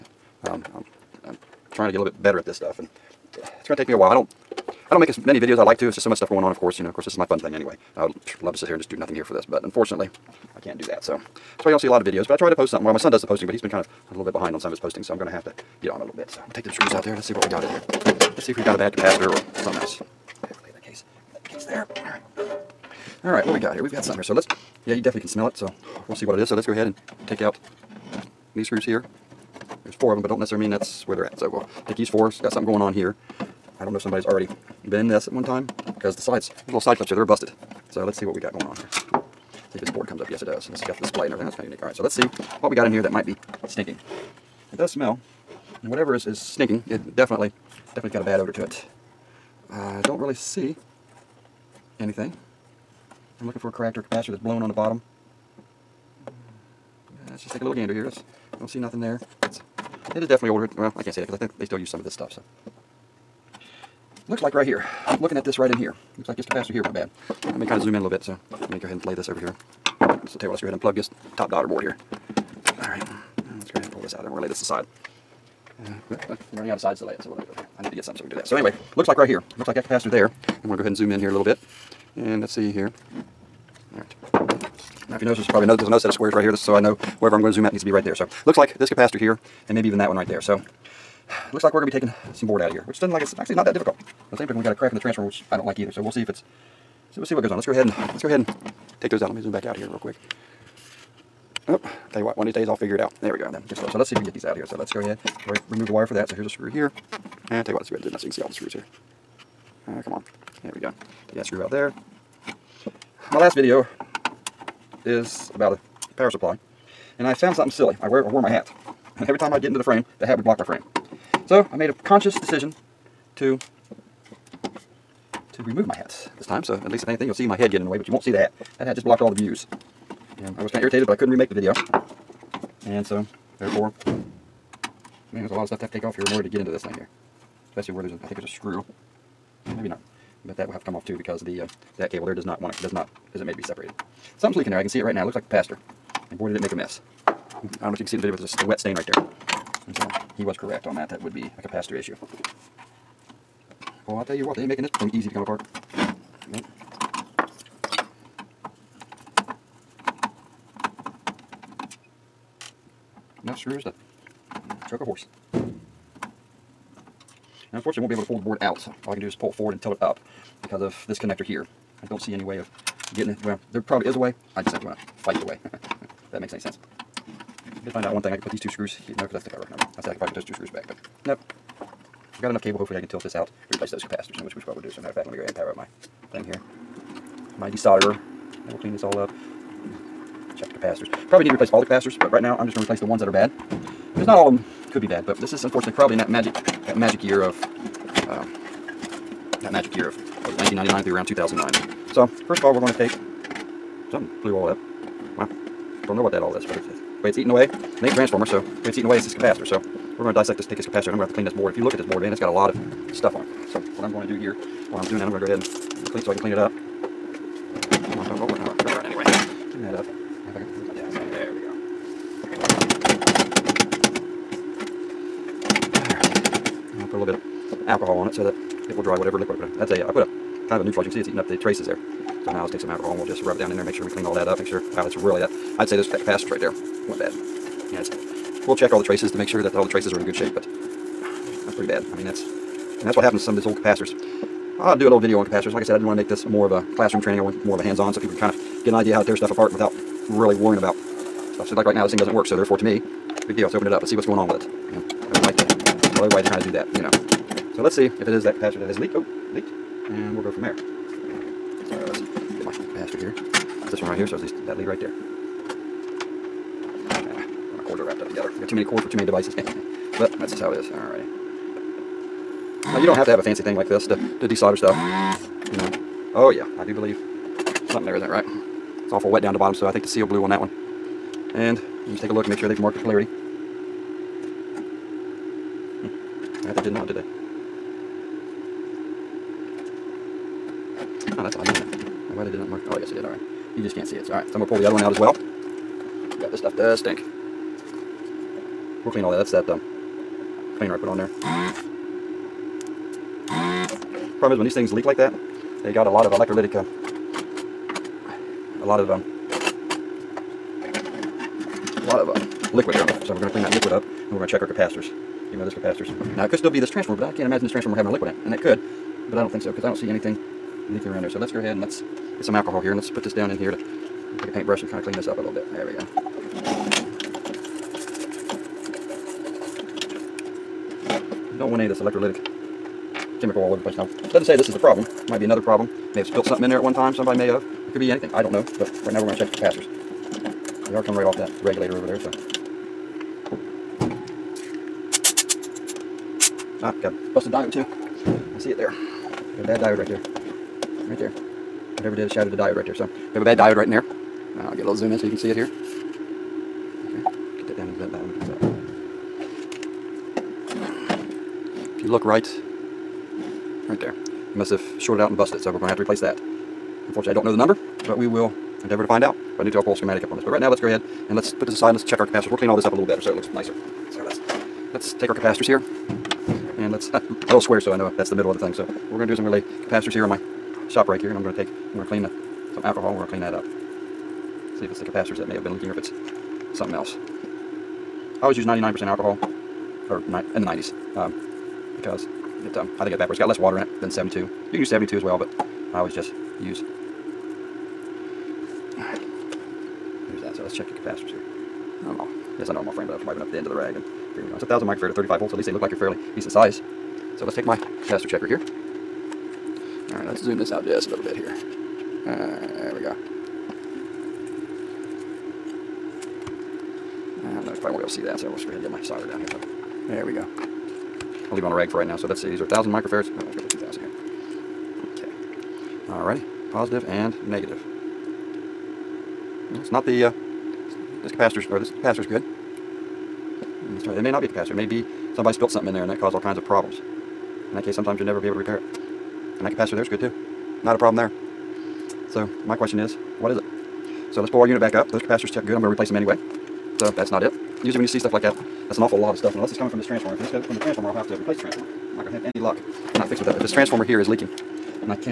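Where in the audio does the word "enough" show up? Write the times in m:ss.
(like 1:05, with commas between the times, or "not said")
2:43, 3:02.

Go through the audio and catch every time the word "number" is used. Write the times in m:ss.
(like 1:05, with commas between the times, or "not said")
6:07.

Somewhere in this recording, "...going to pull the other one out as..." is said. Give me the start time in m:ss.
4:54.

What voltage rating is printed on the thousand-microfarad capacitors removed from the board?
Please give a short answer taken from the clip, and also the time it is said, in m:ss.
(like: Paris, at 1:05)
35 volts, at 6:45.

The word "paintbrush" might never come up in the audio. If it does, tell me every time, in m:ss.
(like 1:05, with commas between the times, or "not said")
5:24.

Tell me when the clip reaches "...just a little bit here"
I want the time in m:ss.
6:50.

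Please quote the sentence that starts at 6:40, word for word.
So let's check your capacitors here.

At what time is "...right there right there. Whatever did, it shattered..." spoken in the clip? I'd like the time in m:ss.
5:49.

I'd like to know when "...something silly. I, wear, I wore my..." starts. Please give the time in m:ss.
1:57.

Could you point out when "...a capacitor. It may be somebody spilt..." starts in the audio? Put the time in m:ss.
7:14.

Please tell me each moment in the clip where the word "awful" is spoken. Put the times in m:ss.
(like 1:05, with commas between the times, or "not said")
4:39, 7:29.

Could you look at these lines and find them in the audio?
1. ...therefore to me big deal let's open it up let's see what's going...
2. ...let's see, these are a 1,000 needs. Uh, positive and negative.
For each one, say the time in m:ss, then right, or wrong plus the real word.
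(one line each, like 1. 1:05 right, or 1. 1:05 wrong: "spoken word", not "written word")
1. 4:12 right
2. 7:02 wrong: "microfarads", not "needs".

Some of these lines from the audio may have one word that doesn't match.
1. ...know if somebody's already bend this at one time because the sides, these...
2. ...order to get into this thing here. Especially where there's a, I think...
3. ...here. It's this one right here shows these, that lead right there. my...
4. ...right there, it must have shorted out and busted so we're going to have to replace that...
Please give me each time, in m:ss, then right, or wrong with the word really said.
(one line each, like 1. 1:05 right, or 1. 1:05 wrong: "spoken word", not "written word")
1. 0:33 right
2. 2:16 right
3. 4:23 right
4. 6:03 right.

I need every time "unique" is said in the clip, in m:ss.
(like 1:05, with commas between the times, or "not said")
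0:41.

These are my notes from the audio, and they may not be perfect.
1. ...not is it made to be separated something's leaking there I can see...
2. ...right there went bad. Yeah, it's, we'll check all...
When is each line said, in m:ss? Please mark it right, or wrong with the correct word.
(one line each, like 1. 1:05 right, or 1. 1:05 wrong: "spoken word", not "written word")
1. 2:22 right
2. 3:56 right.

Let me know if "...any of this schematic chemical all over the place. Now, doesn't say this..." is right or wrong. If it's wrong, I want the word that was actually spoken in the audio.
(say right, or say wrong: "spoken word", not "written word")
wrong: "electrolytic", not "schematic".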